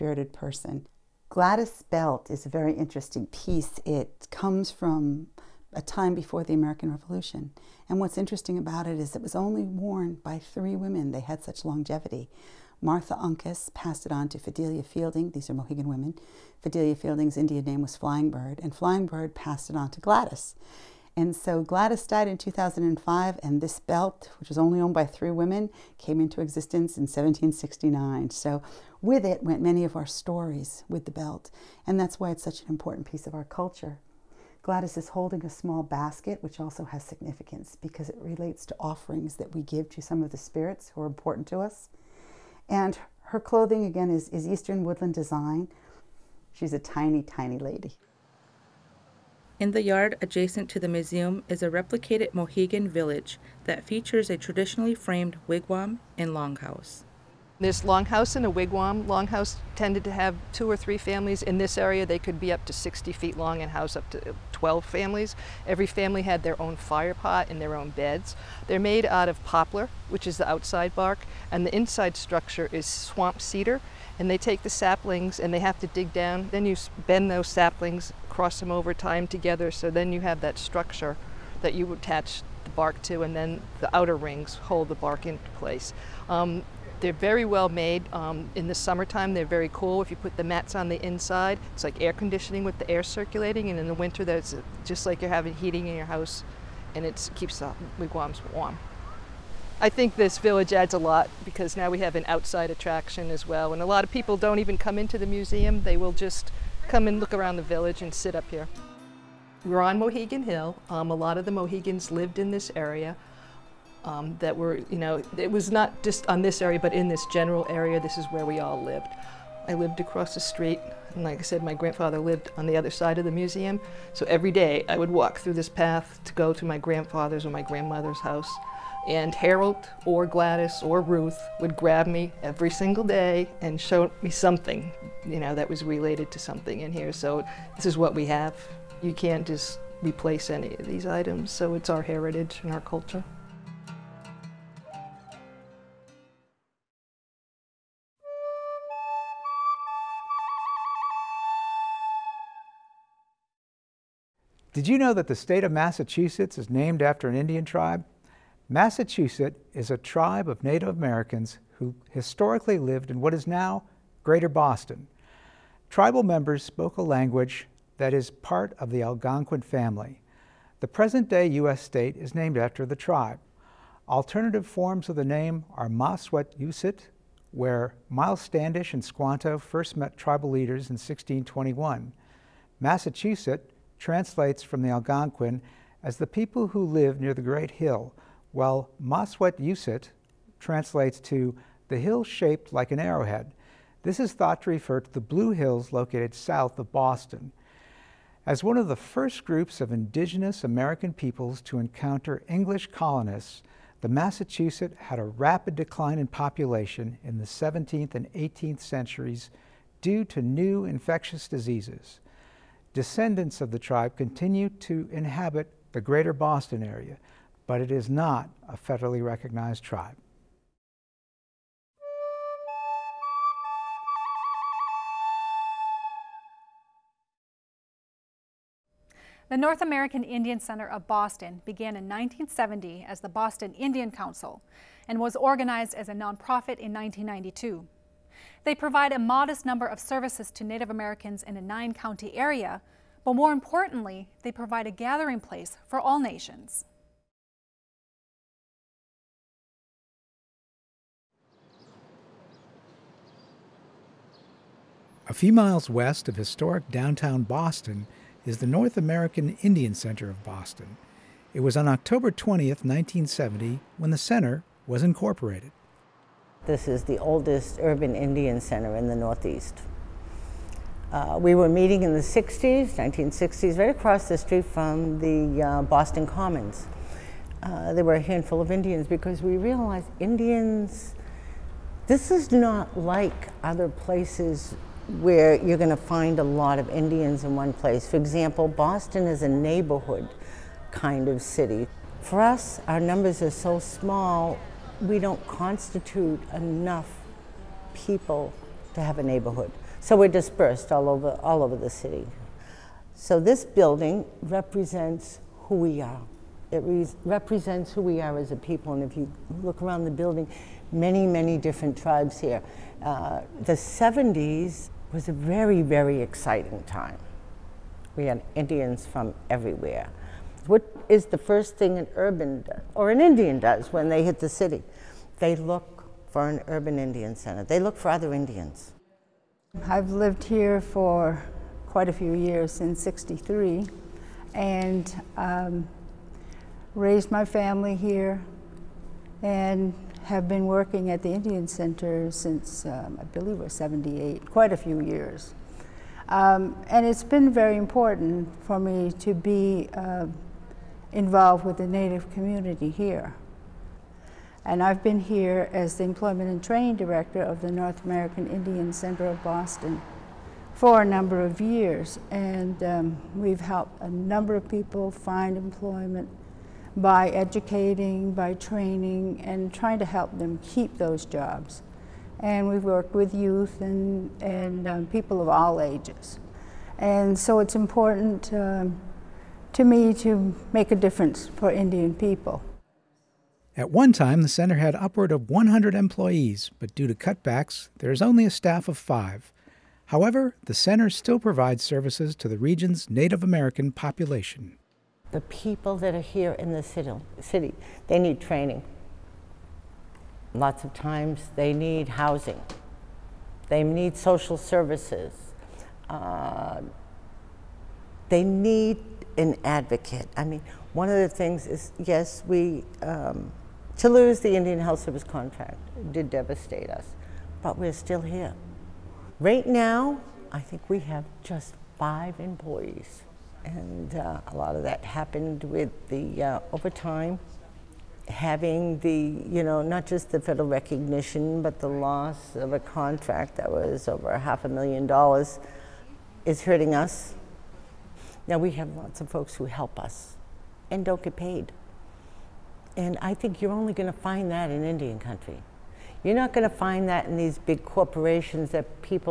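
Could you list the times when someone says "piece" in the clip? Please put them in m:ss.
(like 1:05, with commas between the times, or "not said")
0:03, 0:33.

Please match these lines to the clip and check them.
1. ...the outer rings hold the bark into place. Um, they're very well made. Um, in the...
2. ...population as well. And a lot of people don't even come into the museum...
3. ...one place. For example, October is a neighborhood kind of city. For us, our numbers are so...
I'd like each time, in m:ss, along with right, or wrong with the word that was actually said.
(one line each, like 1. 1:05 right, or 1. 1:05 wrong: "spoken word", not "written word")
1. 1:23 right
2. 1:42 wrong: "attraction", not "population"
3. 4:47 wrong: "Boston", not "October".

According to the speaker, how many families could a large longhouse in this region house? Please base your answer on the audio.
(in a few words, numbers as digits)
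12.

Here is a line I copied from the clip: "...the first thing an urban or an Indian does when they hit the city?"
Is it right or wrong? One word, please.
right.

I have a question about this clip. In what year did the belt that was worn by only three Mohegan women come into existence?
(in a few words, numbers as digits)
1769.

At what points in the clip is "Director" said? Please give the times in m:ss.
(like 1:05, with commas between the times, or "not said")
5:56.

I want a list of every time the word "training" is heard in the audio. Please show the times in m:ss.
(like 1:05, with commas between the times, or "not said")
5:56, 6:08, 6:38.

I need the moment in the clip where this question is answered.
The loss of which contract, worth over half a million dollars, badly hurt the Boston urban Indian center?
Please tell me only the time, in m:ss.
6:54.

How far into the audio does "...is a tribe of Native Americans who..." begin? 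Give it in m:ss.
2:39.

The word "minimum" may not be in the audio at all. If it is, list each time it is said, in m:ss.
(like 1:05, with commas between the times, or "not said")
not said.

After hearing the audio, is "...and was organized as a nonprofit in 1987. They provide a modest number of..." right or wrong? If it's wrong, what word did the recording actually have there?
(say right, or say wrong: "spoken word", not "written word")
wrong: "1992", not "1987".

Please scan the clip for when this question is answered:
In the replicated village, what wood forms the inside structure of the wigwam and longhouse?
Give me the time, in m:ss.
1:12.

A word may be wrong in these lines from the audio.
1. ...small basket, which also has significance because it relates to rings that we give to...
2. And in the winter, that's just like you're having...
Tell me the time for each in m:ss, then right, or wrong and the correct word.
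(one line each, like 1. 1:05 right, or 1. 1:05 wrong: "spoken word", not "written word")
1. 0:35 wrong: "offerings", not "rings"
2. 1:33 right.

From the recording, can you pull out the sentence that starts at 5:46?
Um, and it's been very important for me to be uh, involved with the Native community here.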